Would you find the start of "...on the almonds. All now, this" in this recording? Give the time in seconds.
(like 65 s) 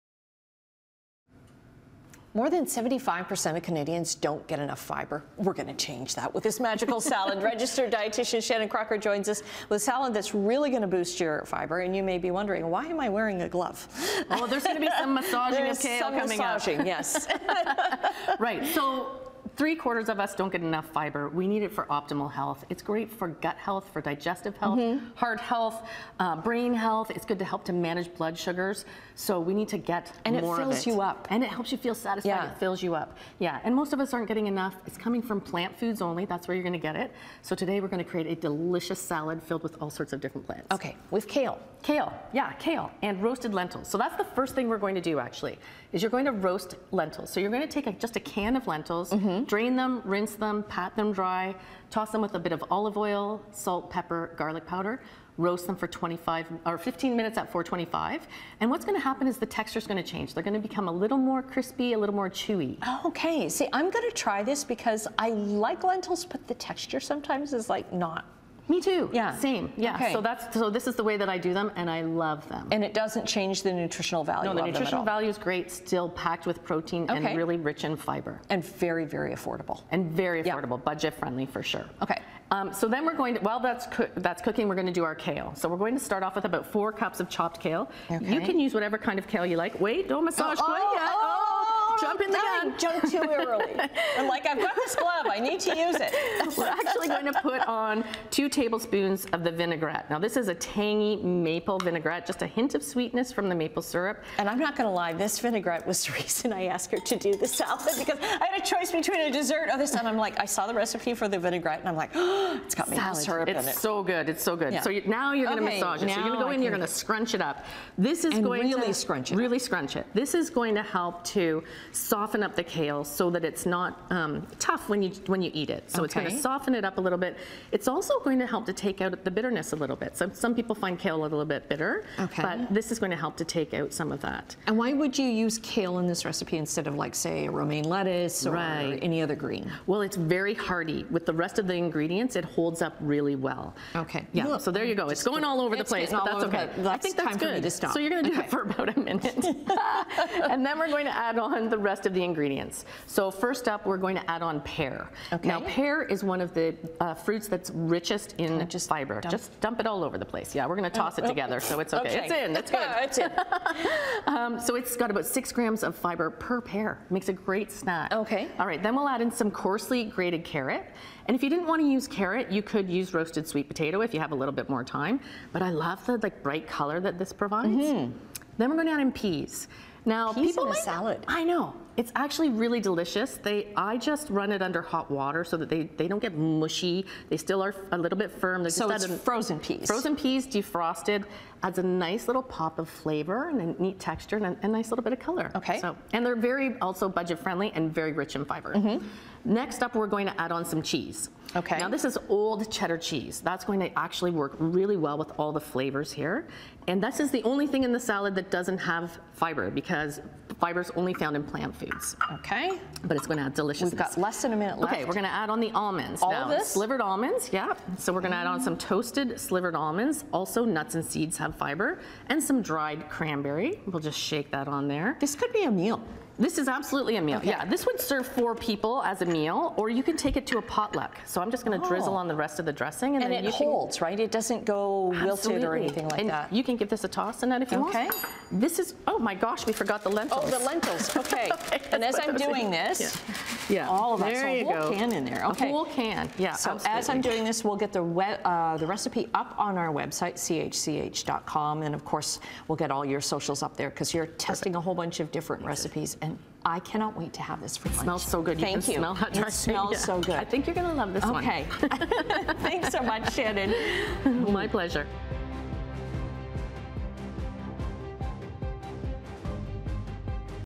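215 s.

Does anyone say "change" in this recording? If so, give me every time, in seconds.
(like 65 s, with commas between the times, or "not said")
5 s, 60 s, 73 s.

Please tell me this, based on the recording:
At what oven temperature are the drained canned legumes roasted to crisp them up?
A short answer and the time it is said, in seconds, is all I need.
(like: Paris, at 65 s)
425, at 57 s.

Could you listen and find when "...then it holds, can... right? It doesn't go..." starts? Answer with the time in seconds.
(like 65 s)
233 s.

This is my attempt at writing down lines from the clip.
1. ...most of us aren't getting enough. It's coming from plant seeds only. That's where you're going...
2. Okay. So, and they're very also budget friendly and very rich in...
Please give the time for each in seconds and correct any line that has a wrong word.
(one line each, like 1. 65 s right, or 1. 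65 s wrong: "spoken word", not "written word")
1. 33 s wrong: "foods", not "seeds"
2. 195 s right.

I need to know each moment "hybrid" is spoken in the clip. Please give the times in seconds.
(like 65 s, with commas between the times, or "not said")
not said.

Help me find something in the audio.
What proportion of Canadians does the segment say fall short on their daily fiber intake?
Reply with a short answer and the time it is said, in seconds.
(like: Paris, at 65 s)
More than 75%, at 2 s.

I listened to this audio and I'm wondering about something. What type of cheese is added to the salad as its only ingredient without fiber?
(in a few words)
old cheddar.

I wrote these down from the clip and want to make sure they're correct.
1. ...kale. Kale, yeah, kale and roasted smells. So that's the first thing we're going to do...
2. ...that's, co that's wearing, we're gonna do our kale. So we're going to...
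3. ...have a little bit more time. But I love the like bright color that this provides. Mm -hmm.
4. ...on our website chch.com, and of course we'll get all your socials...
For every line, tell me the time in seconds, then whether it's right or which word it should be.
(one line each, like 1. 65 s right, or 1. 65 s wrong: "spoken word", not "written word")
1. 41 s wrong: "lentils", not "smells"
2. 83 s wrong: "cooking", not "wearing"
3. 174 s right
4. 249 s right.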